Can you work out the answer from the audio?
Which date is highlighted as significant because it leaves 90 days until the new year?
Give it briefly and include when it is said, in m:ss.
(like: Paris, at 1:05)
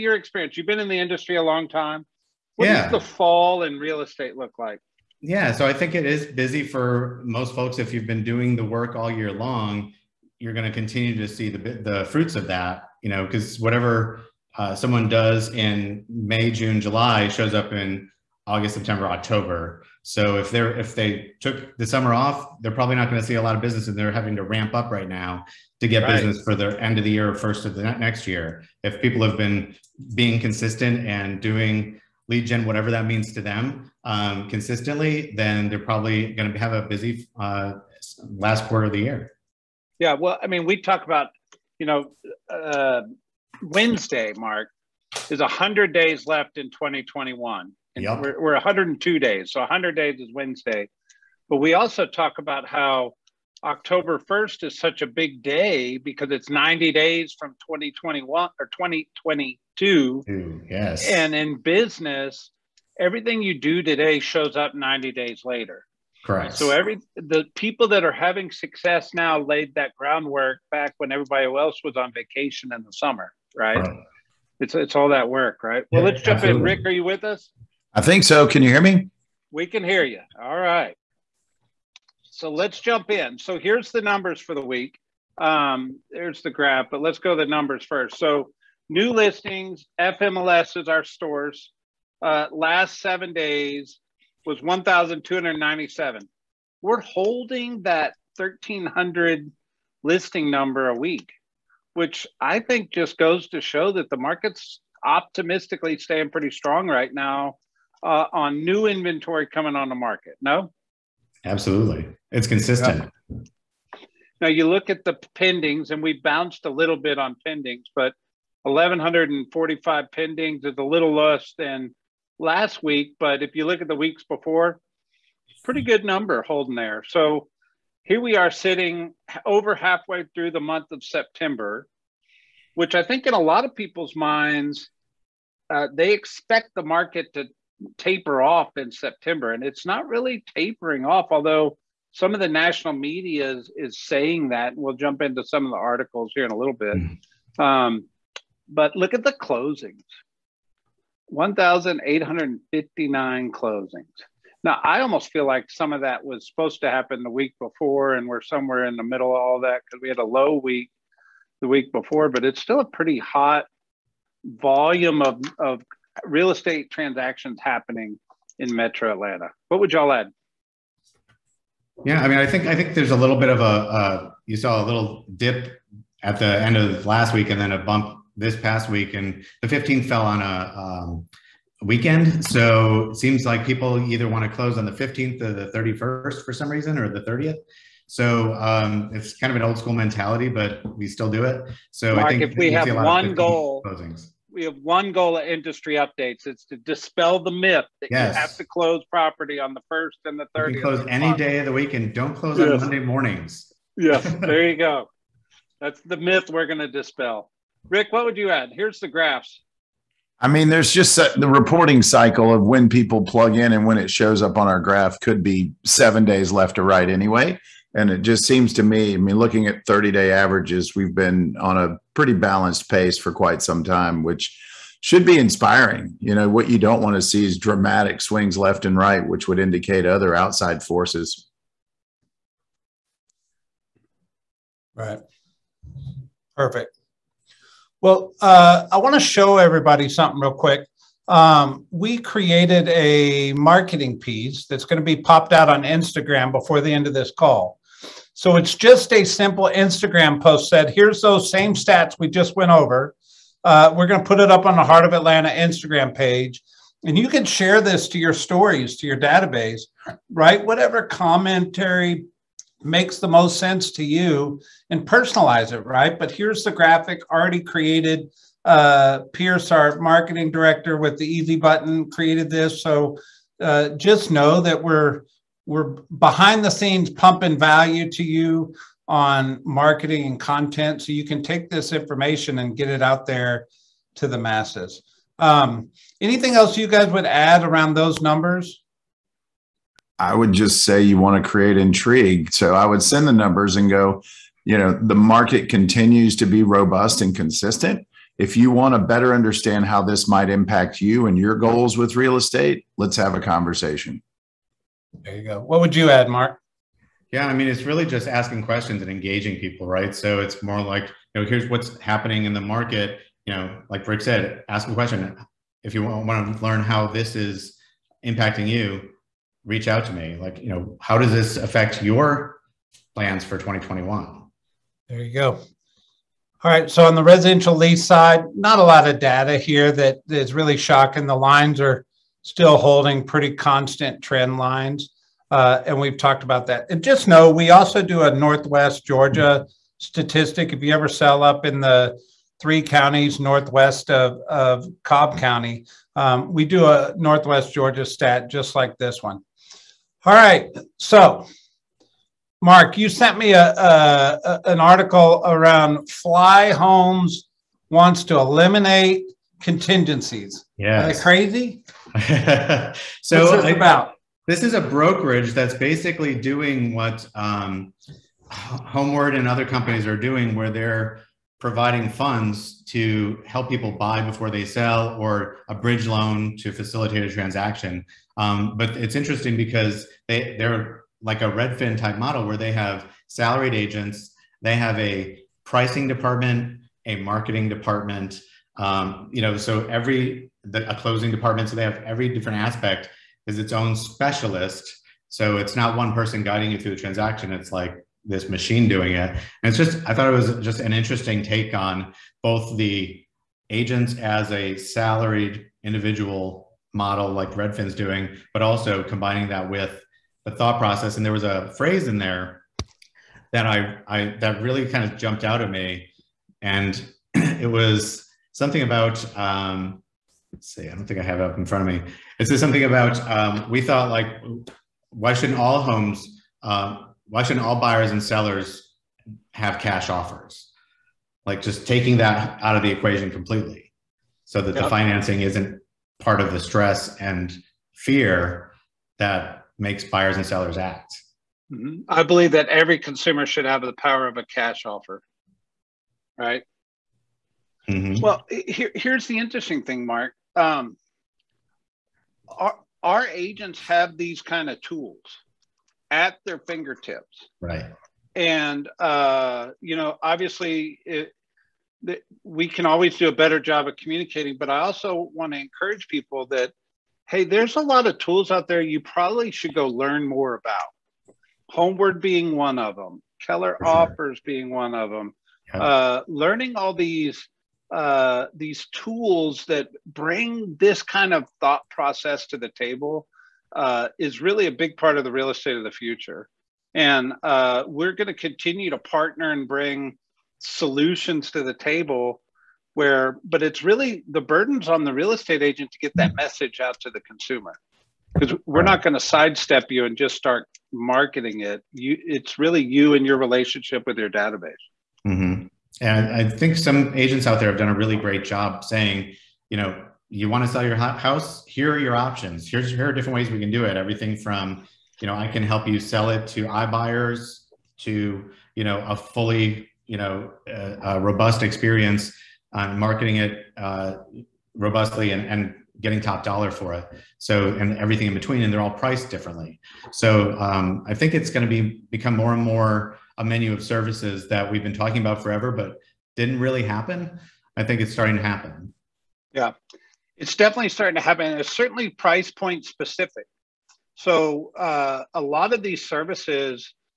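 October 1st, at 0:53.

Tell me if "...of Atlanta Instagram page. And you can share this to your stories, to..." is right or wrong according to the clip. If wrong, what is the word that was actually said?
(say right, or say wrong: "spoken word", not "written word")
right.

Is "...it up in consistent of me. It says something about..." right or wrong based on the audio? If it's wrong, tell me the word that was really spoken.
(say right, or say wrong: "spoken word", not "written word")
wrong: "front", not "consistent".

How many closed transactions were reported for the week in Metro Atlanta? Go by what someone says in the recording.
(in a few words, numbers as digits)
1,859.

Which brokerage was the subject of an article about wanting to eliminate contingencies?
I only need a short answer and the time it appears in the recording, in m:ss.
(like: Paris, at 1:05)
Flyhomes, at 5:56.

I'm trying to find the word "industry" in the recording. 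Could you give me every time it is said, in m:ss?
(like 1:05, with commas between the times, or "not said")
0:00, 3:15.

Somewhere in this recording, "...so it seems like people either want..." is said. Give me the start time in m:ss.
3:02.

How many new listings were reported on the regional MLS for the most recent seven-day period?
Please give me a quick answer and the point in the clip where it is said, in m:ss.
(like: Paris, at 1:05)
1,297, at 1:34.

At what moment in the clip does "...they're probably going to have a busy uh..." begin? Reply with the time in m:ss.
0:35.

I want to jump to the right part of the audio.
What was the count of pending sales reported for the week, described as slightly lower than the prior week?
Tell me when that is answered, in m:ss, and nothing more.
1:58.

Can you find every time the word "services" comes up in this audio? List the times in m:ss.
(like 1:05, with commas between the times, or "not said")
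8:53, 9:06.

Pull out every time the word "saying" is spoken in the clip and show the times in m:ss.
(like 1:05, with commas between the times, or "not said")
2:24, 8:28.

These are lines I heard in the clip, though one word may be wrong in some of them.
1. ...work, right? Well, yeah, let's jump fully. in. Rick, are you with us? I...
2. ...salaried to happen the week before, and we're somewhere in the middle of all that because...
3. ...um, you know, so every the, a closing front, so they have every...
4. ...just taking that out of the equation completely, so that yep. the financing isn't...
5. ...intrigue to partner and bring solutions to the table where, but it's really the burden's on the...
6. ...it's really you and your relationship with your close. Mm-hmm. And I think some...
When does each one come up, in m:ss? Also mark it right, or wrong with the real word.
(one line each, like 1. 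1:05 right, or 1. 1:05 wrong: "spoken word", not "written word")
1. 1:15 wrong: "absolutely", not "fully"
2. 2:36 wrong: "supposed", not "salaried"
3. 6:28 wrong: "department", not "front"
4. 7:11 right
5. 8:08 wrong: "continue", not "intrigue"
6. 8:22 wrong: "database", not "close".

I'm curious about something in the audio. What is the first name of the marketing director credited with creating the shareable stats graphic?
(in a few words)
Pierce.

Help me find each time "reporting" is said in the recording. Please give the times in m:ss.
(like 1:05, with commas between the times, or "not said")
3:31.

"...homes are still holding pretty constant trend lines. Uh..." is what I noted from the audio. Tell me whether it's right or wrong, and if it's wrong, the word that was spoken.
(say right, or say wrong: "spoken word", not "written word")
wrong: "lines", not "homes".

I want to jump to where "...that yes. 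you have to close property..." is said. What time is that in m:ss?
3:18.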